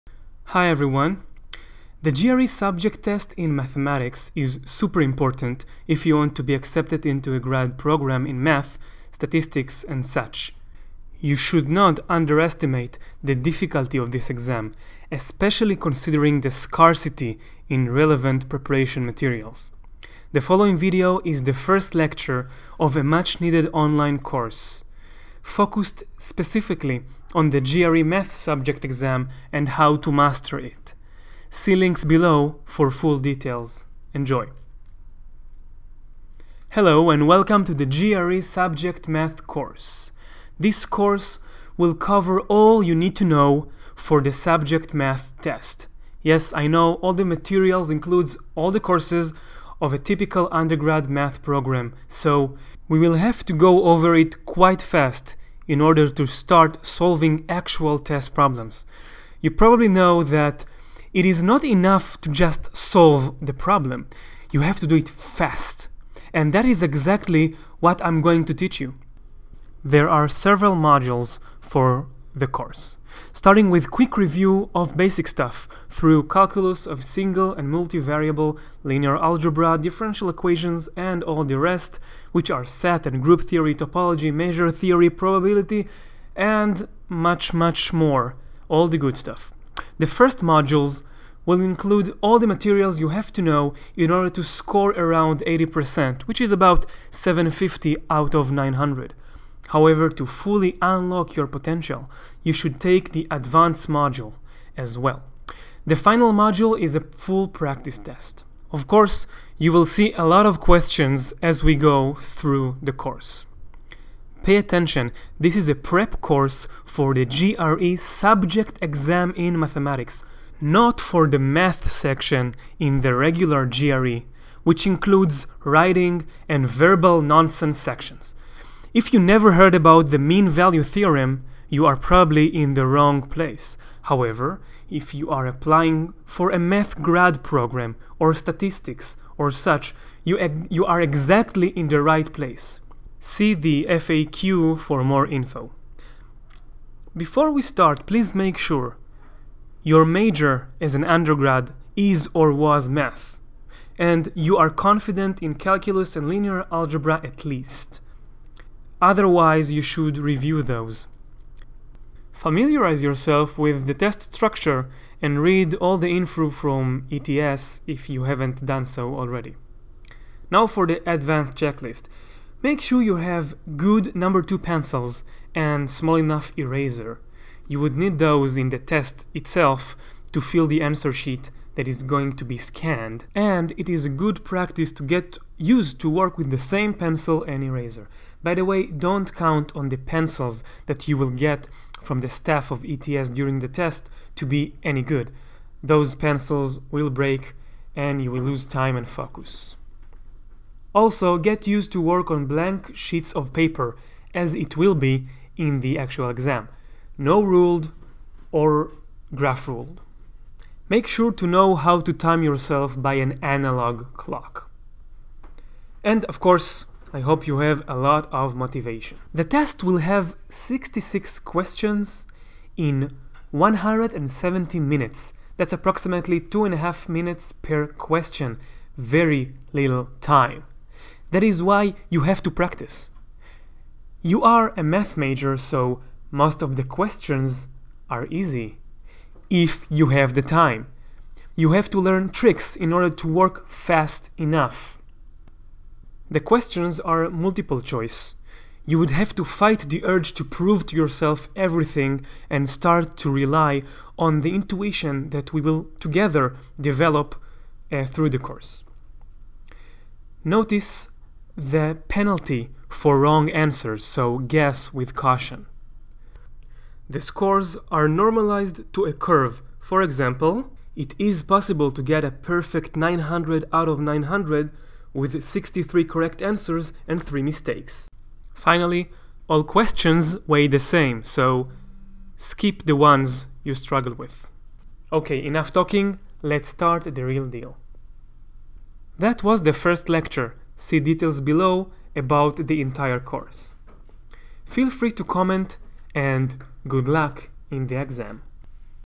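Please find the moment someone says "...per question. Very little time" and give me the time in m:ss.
3:47.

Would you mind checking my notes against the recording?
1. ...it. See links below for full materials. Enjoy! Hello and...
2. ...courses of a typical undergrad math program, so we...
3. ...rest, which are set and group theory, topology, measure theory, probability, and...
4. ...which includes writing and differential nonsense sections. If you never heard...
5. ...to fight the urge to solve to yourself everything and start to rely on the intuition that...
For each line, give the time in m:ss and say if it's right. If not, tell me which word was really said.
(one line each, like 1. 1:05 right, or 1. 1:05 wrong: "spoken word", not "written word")
1. 0:30 wrong: "details", not "materials"
2. 0:48 right
3. 1:21 right
4. 2:04 wrong: "verbal", not "differential"
5. 4:09 wrong: "prove", not "solve".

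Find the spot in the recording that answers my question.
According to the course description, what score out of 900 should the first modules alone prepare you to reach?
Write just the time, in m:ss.
1:37.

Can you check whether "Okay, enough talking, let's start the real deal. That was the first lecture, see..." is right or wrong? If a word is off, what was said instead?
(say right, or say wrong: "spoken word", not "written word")
right.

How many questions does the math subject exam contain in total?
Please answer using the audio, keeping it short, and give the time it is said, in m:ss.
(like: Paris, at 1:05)
66, at 3:40.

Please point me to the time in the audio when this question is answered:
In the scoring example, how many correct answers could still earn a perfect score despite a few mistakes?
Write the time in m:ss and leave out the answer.
4:35.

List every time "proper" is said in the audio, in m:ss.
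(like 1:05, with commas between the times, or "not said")
not said.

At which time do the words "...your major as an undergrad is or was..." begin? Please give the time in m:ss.
2:29.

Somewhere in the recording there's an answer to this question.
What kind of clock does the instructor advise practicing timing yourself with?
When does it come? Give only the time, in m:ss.
3:33.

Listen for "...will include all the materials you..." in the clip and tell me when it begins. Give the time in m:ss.
1:31.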